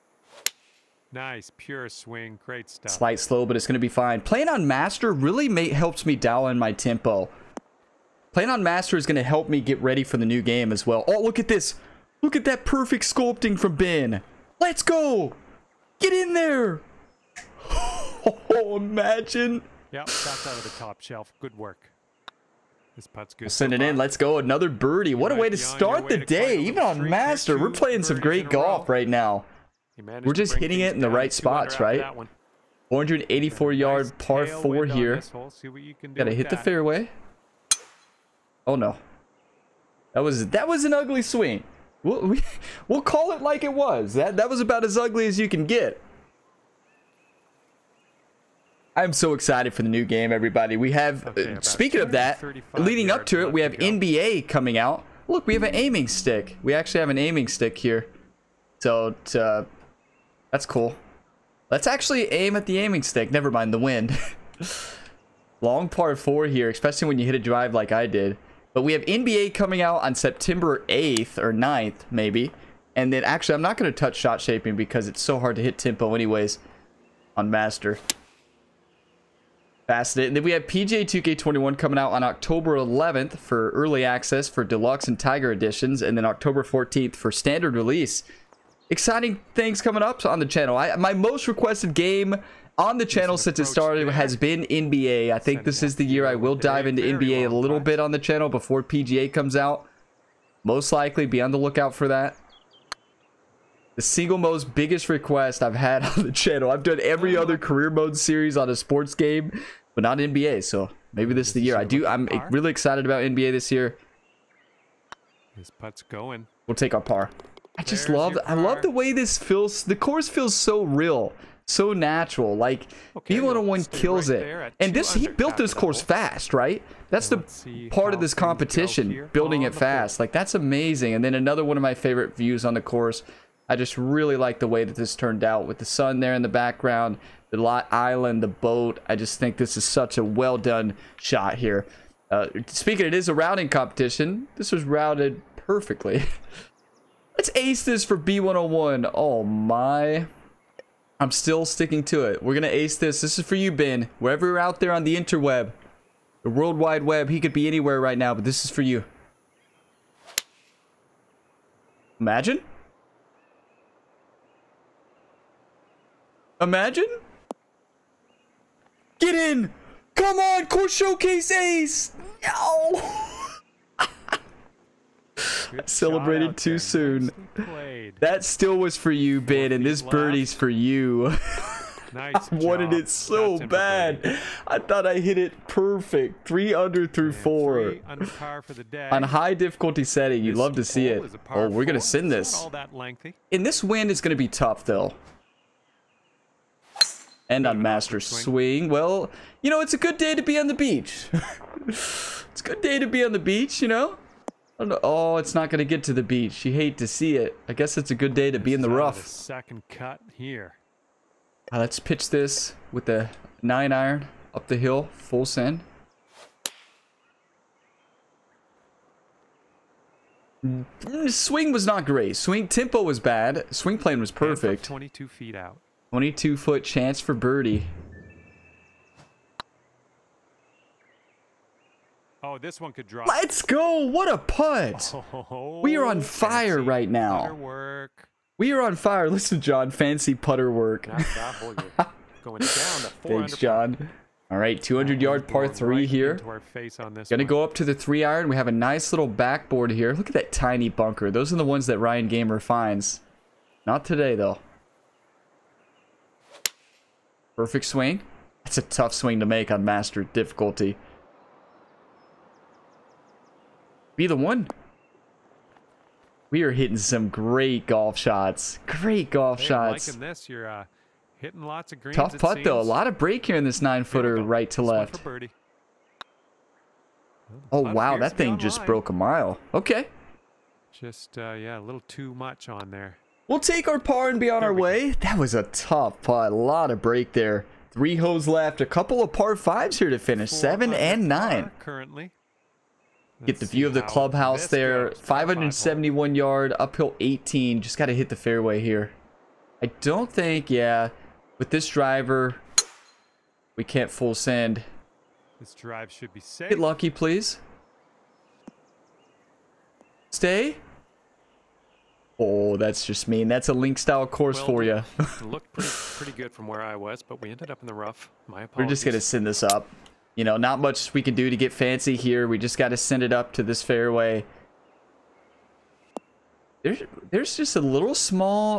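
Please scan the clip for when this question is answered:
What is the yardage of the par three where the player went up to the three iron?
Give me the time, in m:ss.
4:04.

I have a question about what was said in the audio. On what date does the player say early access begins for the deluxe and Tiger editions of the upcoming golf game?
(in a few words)
October 11th.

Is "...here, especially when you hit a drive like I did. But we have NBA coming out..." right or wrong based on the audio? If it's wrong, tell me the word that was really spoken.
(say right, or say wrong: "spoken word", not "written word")
right.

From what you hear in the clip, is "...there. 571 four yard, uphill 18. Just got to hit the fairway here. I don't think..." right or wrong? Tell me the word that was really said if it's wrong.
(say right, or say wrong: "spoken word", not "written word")
wrong: "five", not "four".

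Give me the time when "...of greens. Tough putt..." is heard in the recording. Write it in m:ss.
4:31.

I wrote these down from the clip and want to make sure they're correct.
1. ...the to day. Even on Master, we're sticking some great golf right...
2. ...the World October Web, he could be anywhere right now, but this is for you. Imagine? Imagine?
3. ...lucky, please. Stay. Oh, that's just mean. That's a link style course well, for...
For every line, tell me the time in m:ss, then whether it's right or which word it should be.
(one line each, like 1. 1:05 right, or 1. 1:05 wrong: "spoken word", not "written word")
1. 0:26 wrong: "playing", not "sticking"
2. 2:36 wrong: "Wide", not "October"
3. 5:06 right.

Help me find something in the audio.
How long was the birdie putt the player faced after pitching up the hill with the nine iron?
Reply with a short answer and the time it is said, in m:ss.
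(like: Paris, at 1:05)
22 feet, at 3:44.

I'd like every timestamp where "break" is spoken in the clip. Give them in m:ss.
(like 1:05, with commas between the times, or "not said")
4:33, 4:47.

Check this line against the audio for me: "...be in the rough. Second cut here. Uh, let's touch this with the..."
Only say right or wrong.
wrong.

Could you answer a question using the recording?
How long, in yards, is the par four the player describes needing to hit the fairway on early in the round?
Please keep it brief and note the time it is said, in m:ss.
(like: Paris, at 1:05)
484, at 0:32.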